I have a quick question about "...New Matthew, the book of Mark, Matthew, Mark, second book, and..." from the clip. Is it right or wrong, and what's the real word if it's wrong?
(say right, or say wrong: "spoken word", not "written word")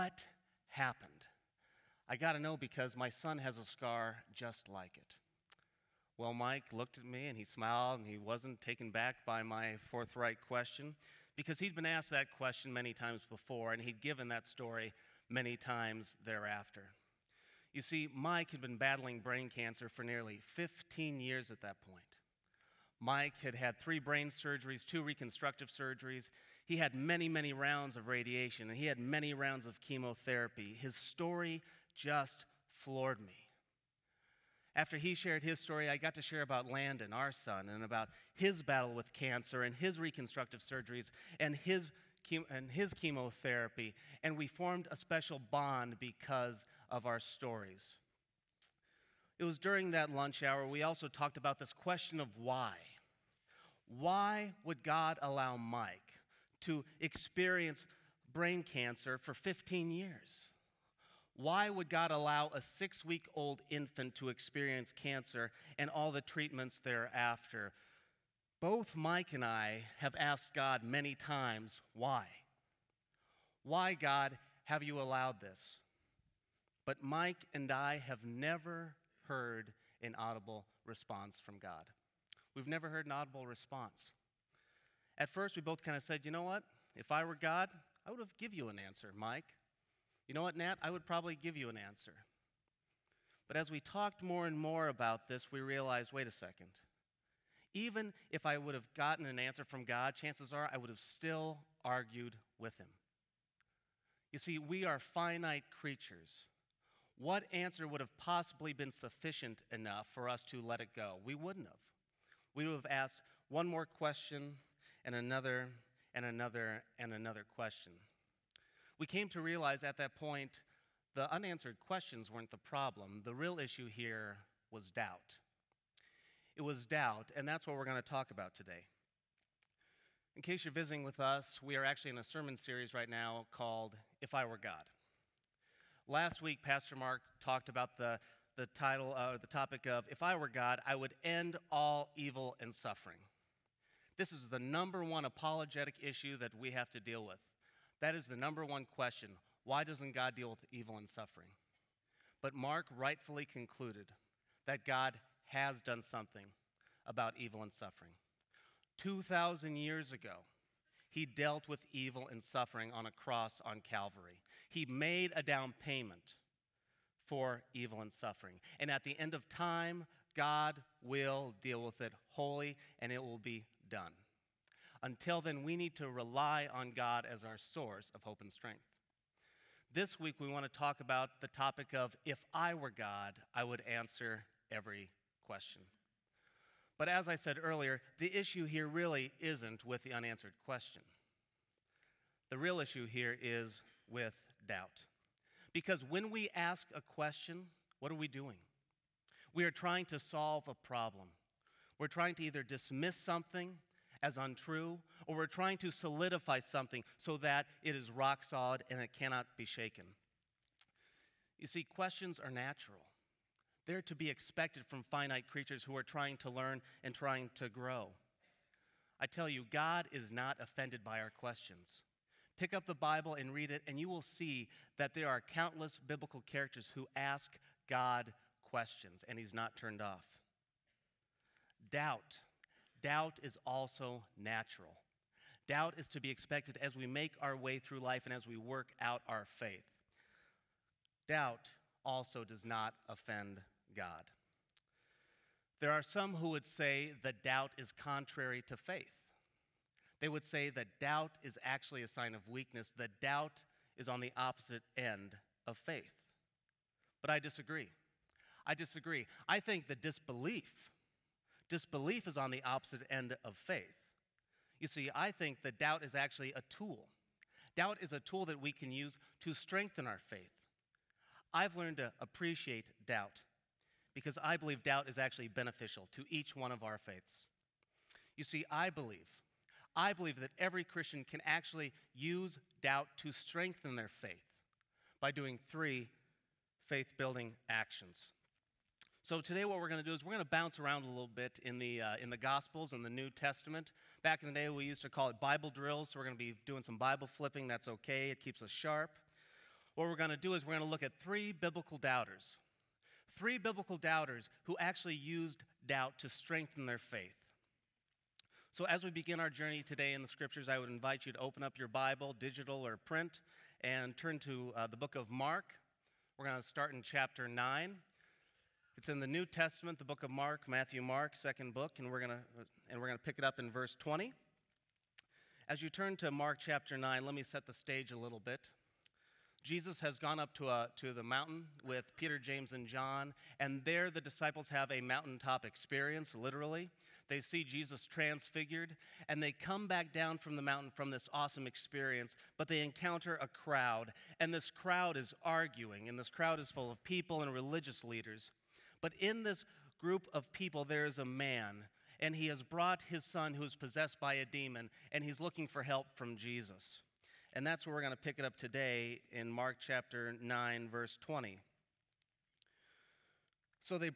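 wrong: "Testament", not "Matthew".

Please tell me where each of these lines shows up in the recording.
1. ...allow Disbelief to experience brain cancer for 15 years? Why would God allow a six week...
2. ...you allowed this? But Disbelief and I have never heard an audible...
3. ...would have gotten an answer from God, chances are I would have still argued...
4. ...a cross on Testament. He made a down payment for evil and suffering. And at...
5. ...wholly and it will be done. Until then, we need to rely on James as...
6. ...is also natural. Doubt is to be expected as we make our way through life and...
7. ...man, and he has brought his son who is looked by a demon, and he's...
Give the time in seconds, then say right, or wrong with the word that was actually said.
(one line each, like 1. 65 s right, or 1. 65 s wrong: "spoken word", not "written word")
1. 55 s wrong: "Mike", not "Disbelief"
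2. 74 s wrong: "Mike", not "Disbelief"
3. 98 s right
4. 163 s wrong: "Calvary", not "Testament"
5. 172 s wrong: "God", not "James"
6. 233 s right
7. 351 s wrong: "possessed", not "looked".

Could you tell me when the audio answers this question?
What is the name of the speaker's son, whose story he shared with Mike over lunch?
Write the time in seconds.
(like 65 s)
36 s.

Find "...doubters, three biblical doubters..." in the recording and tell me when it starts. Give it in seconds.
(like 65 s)
301 s.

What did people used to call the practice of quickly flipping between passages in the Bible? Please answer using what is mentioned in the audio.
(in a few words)
Bible drills.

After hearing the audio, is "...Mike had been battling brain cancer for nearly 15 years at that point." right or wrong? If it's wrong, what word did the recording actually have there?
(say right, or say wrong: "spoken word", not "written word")
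right.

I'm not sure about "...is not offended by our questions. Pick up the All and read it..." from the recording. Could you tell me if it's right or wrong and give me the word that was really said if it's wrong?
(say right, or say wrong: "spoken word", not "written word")
wrong: "Bible", not "All".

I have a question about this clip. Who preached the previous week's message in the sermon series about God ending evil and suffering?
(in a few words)
Pastor Mark.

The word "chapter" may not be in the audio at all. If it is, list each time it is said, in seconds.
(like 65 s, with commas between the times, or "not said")
317 s, 326 s, 359 s.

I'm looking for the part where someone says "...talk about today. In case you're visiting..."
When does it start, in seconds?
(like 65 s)
128 s.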